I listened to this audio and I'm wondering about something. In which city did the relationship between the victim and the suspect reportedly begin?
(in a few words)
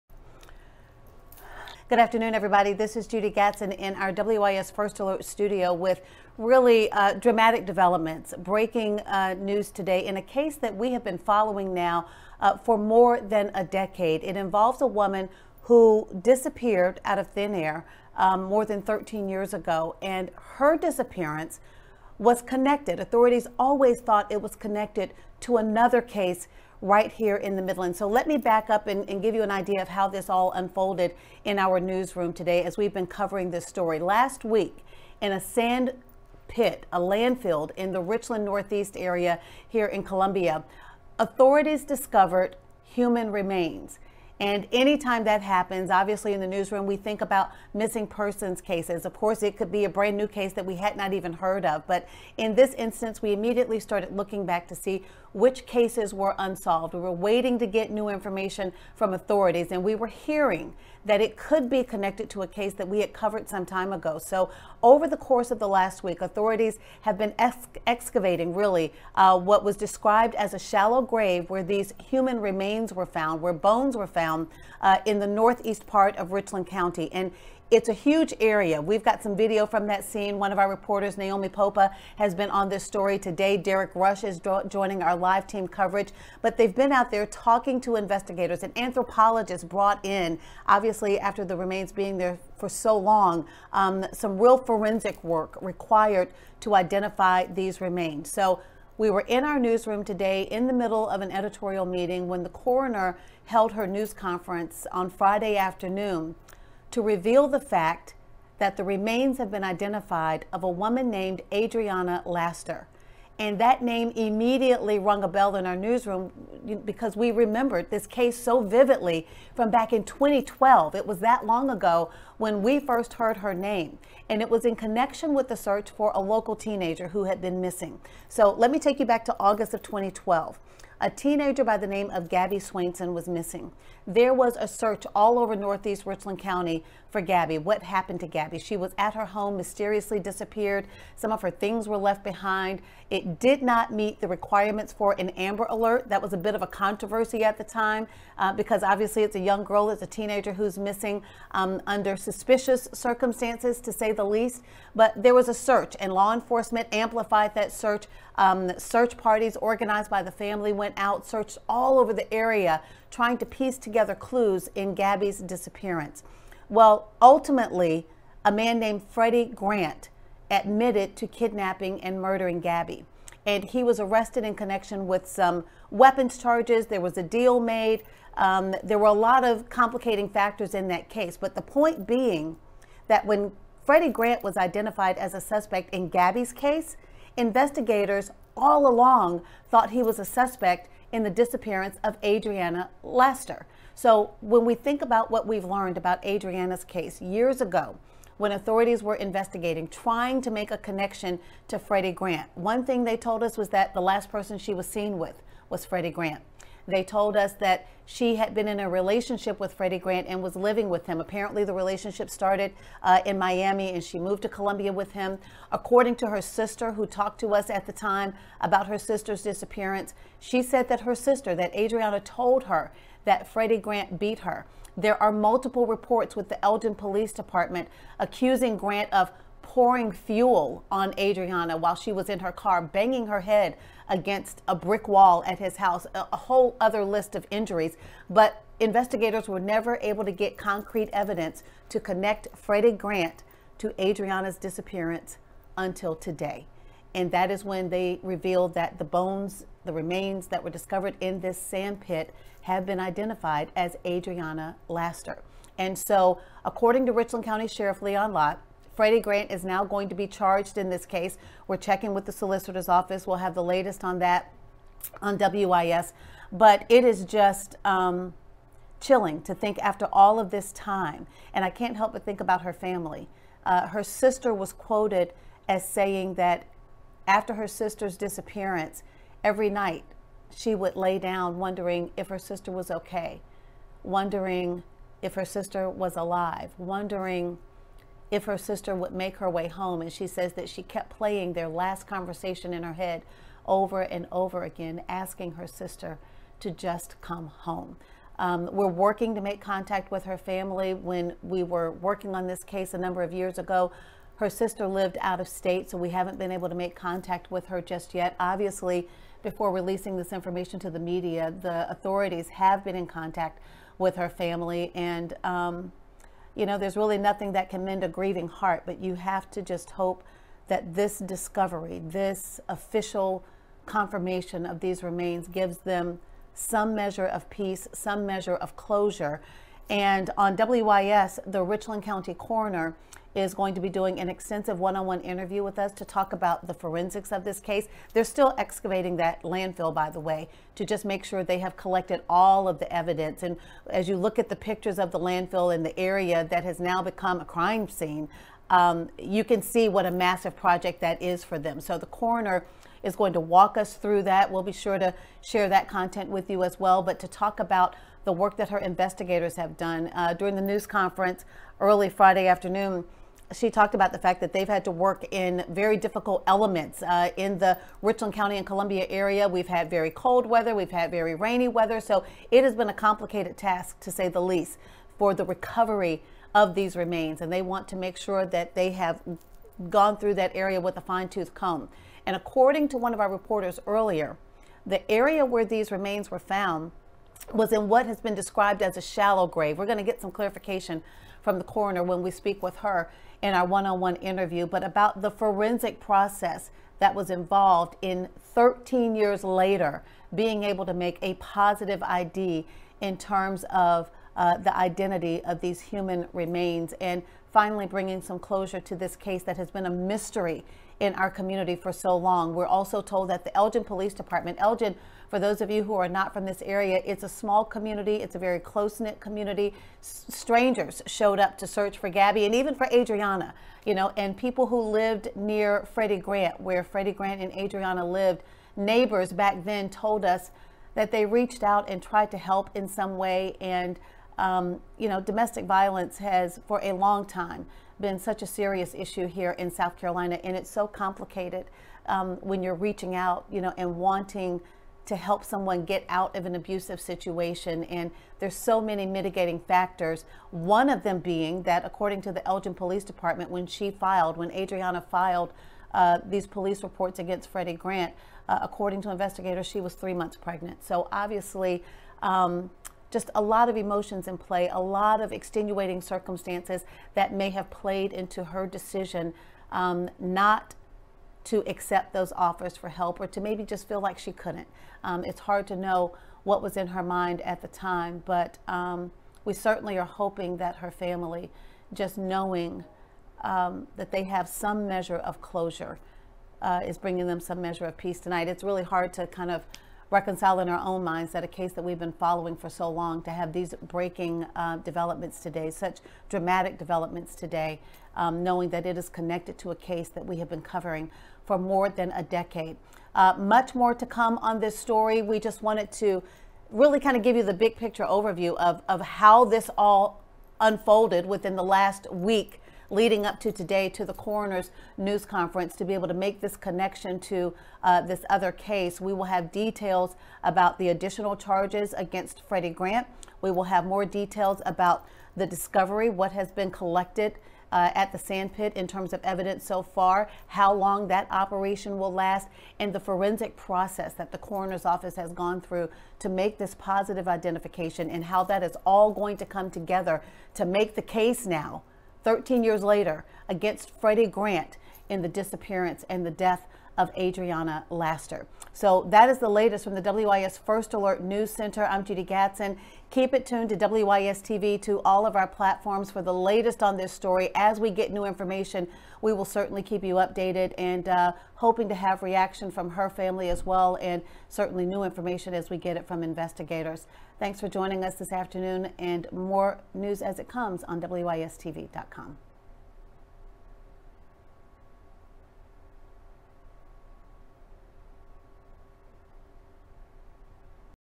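Miami.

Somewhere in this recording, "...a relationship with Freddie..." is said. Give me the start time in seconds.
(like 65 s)
208 s.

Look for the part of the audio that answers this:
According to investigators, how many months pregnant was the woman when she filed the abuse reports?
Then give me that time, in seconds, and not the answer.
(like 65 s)
459 s.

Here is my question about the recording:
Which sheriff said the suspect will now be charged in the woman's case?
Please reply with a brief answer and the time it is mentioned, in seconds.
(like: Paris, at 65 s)
Leon Lott, at 258 s.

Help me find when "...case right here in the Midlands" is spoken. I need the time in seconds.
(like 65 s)
26 s.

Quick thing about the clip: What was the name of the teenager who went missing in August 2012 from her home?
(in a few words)
Gabby Swainson.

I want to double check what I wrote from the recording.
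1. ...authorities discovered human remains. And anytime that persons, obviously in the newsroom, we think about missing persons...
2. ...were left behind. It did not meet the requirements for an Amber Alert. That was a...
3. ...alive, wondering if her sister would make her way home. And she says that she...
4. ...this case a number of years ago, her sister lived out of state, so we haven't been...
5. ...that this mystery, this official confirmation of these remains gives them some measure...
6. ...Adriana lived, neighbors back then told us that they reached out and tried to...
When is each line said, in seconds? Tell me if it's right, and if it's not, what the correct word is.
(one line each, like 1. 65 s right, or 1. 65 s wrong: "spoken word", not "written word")
1. 41 s wrong: "happens", not "persons"
2. 141 s right
3. 286 s right
4. 302 s right
5. 320 s wrong: "discovery", not "mystery"
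6. 427 s right.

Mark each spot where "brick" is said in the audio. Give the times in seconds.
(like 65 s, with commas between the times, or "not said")
234 s.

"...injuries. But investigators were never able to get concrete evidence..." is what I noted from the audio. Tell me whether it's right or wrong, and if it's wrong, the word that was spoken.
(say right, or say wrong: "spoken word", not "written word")
right.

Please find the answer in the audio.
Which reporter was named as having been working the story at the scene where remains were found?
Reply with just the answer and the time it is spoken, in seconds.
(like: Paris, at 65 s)
Naomi Popa, at 81 s.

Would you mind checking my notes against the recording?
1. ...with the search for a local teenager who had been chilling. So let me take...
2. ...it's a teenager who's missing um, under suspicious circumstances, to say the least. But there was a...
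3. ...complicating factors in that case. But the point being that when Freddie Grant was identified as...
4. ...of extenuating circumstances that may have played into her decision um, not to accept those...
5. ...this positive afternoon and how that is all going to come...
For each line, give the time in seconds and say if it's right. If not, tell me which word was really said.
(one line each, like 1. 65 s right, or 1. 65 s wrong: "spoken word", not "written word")
1. 125 s wrong: "missing", not "chilling"
2. 149 s right
3. 179 s right
4. 465 s right
5. 536 s wrong: "identification", not "afternoon".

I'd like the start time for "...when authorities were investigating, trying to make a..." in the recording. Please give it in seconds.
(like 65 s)
198 s.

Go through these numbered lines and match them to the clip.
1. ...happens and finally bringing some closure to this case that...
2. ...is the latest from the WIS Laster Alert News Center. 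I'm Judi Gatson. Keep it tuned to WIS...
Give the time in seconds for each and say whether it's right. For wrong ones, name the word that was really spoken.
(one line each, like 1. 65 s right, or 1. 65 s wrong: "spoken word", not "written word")
1. 406 s wrong: "remains", not "happens"
2. 549 s wrong: "First", not "Laster".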